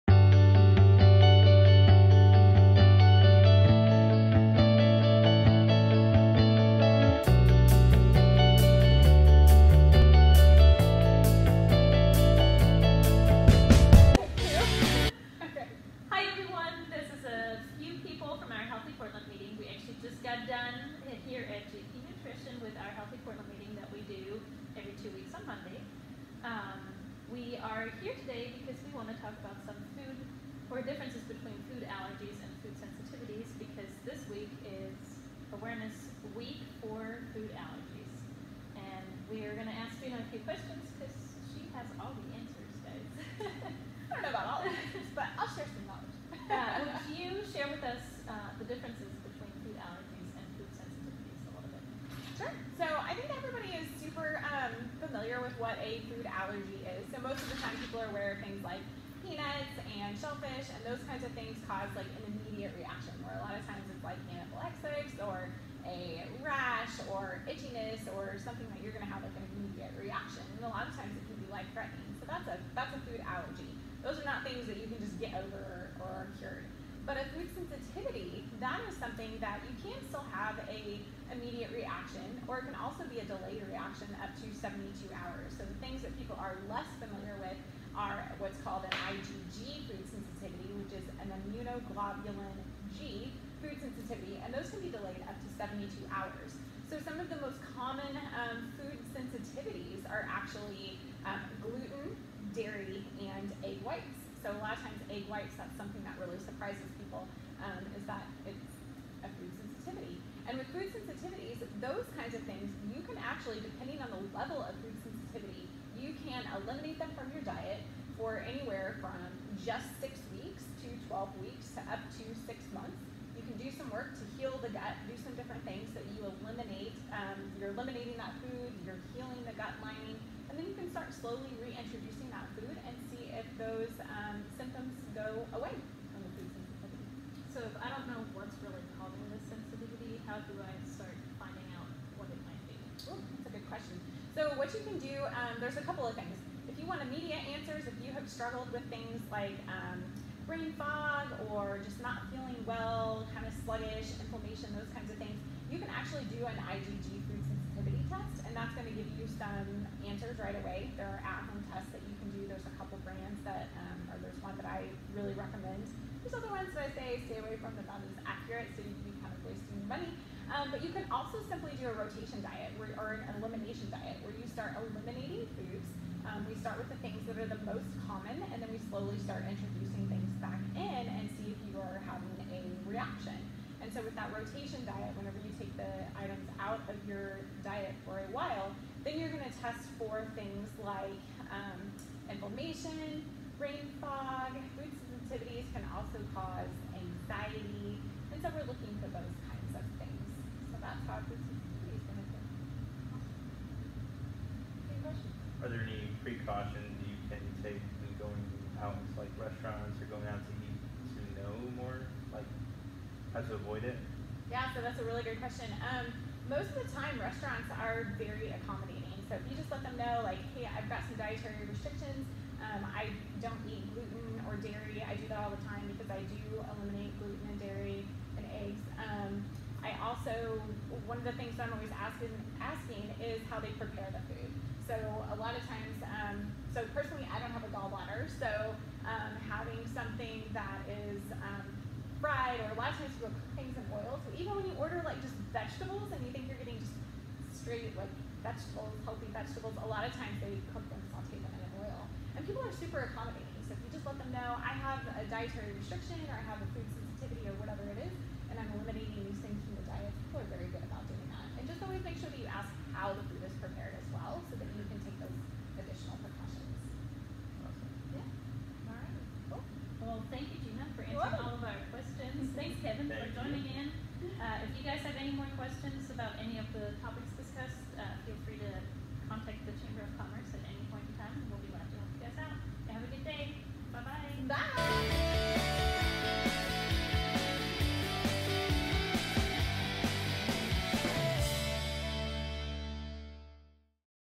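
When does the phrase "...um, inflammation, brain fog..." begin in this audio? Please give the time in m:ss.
3:11.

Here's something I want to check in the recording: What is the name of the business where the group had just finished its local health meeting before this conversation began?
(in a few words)
GP Nutrition.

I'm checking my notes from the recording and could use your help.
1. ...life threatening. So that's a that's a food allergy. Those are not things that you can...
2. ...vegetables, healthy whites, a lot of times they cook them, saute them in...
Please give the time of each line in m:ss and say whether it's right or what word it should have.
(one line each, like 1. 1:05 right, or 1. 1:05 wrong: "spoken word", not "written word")
1. 1:11 right
2. 4:08 wrong: "vegetables", not "whites".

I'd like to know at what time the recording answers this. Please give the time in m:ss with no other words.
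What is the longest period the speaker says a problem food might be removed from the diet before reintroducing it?
2:02.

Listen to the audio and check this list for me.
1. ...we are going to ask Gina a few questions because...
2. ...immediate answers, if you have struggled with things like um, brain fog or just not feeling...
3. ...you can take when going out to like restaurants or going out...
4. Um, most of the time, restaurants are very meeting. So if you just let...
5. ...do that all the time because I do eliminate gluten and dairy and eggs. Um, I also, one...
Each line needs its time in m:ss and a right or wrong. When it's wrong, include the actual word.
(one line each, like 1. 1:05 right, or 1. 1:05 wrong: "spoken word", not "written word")
1. 0:39 right
2. 2:27 right
3. 3:27 right
4. 3:35 wrong: "accommodating", not "meeting"
5. 3:45 right.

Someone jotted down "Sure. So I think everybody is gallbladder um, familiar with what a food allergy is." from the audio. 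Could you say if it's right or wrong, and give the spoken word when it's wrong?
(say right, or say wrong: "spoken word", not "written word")
wrong: "super", not "gallbladder".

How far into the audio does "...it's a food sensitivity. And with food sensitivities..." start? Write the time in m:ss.
1:48.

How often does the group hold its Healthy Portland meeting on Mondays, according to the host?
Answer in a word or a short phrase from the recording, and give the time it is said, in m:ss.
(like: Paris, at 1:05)
Every two weeks, at 0:24.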